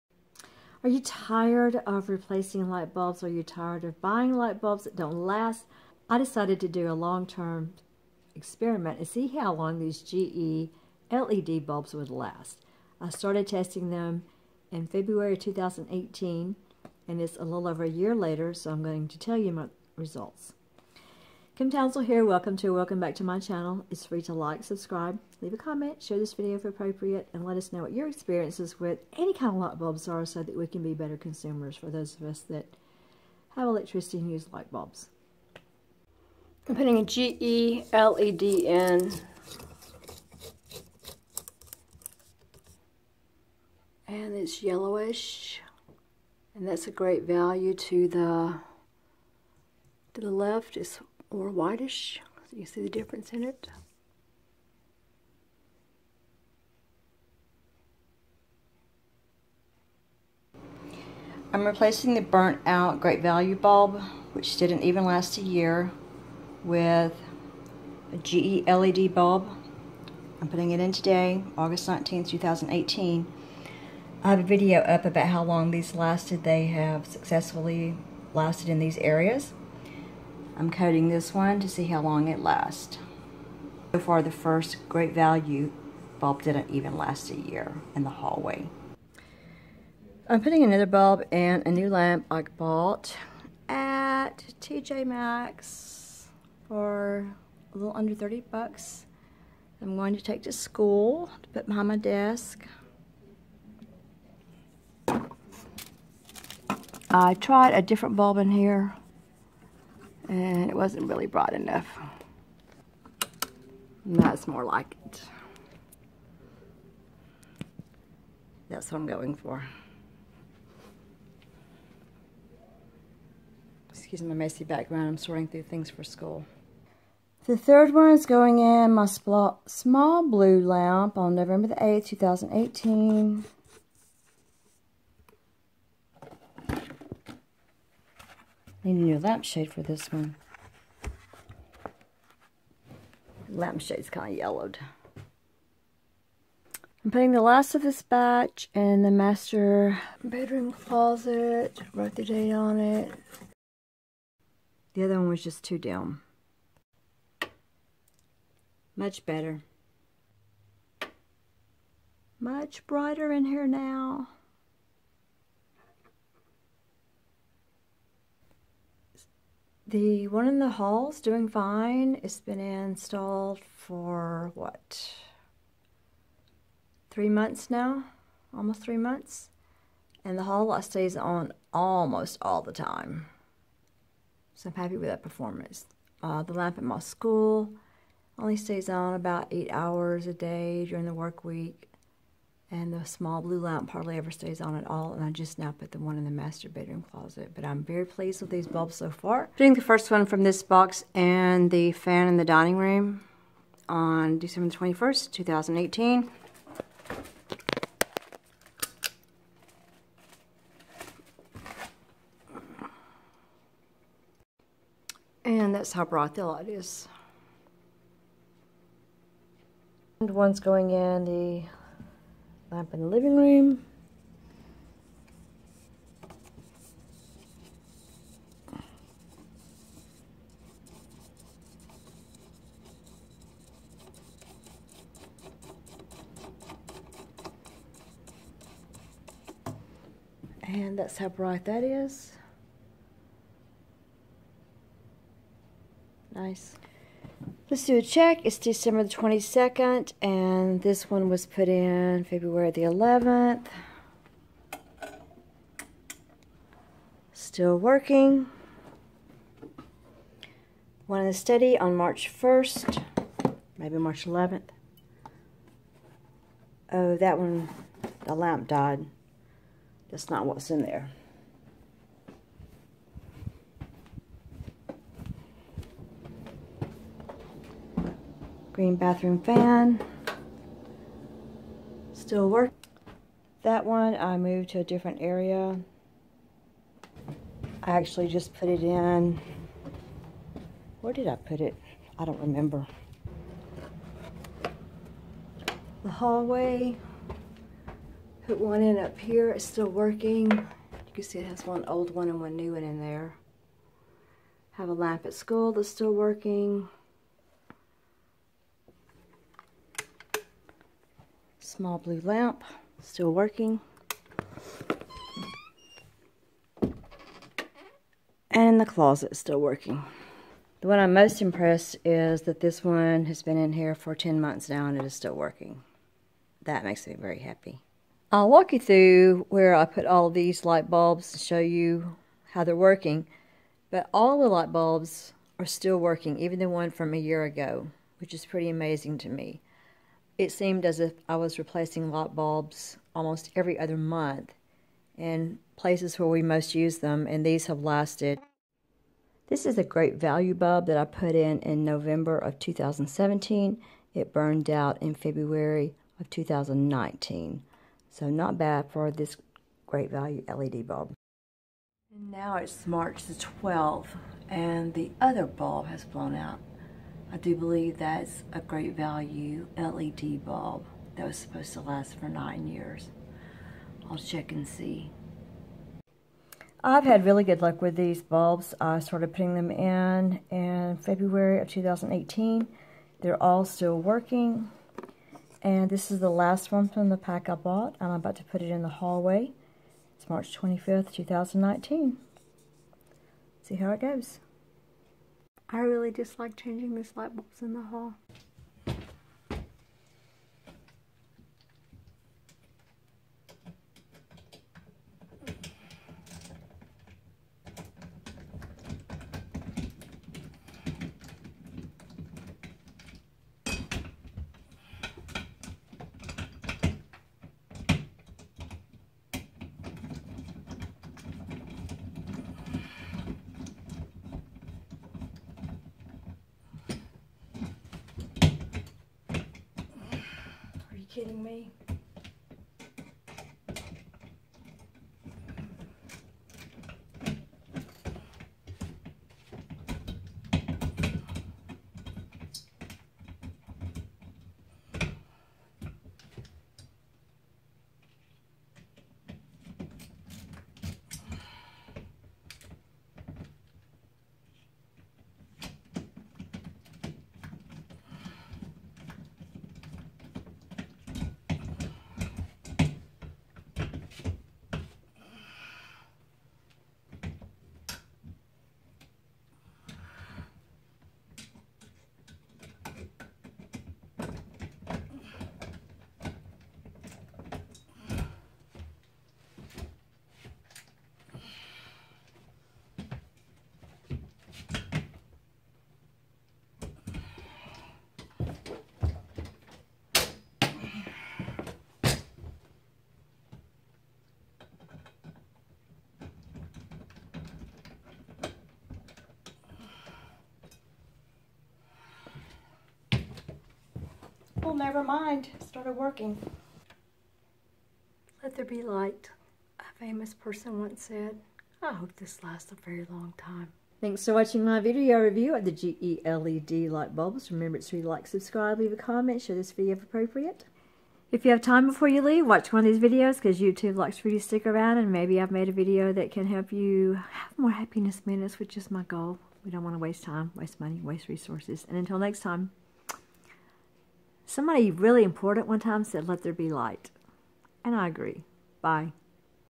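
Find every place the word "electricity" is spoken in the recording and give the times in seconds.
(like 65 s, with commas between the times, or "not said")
33 s.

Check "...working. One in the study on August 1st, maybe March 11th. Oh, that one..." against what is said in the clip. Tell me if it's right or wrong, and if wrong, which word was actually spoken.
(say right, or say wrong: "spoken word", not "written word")
wrong: "March", not "August".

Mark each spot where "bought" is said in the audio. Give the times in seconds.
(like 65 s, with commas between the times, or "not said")
92 s, 387 s.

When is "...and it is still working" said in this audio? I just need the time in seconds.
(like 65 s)
324 s.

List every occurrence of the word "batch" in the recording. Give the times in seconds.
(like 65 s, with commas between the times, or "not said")
148 s.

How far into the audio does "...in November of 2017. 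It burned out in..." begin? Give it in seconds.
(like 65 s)
351 s.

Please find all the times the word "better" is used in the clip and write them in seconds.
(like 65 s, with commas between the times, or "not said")
30 s, 159 s.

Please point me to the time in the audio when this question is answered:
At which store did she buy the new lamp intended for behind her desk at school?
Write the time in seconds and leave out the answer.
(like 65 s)
94 s.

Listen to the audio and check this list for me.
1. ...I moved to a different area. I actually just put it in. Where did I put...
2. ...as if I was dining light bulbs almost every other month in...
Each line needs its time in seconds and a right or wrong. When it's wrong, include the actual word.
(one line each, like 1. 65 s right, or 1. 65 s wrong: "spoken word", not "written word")
1. 284 s right
2. 340 s wrong: "replacing", not "dining".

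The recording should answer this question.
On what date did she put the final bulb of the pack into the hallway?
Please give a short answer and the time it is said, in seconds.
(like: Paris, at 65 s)
March 25, 2019, at 390 s.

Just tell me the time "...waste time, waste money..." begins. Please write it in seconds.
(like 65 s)
529 s.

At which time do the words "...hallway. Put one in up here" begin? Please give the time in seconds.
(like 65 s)
296 s.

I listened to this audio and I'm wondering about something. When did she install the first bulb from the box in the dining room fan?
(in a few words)
December 21, 2018.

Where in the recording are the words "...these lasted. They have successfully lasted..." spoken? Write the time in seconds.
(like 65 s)
75 s.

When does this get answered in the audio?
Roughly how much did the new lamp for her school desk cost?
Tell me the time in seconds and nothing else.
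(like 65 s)
97 s.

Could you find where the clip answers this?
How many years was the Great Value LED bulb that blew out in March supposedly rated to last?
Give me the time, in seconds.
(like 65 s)
372 s.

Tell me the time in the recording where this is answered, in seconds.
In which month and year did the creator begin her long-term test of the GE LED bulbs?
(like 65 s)
14 s.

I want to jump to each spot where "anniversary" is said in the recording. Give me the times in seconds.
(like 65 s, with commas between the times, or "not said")
not said.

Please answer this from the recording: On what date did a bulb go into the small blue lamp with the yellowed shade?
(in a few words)
November 8, 2018.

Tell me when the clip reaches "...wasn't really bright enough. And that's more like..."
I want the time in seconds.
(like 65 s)
110 s.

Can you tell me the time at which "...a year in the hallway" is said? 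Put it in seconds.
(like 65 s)
87 s.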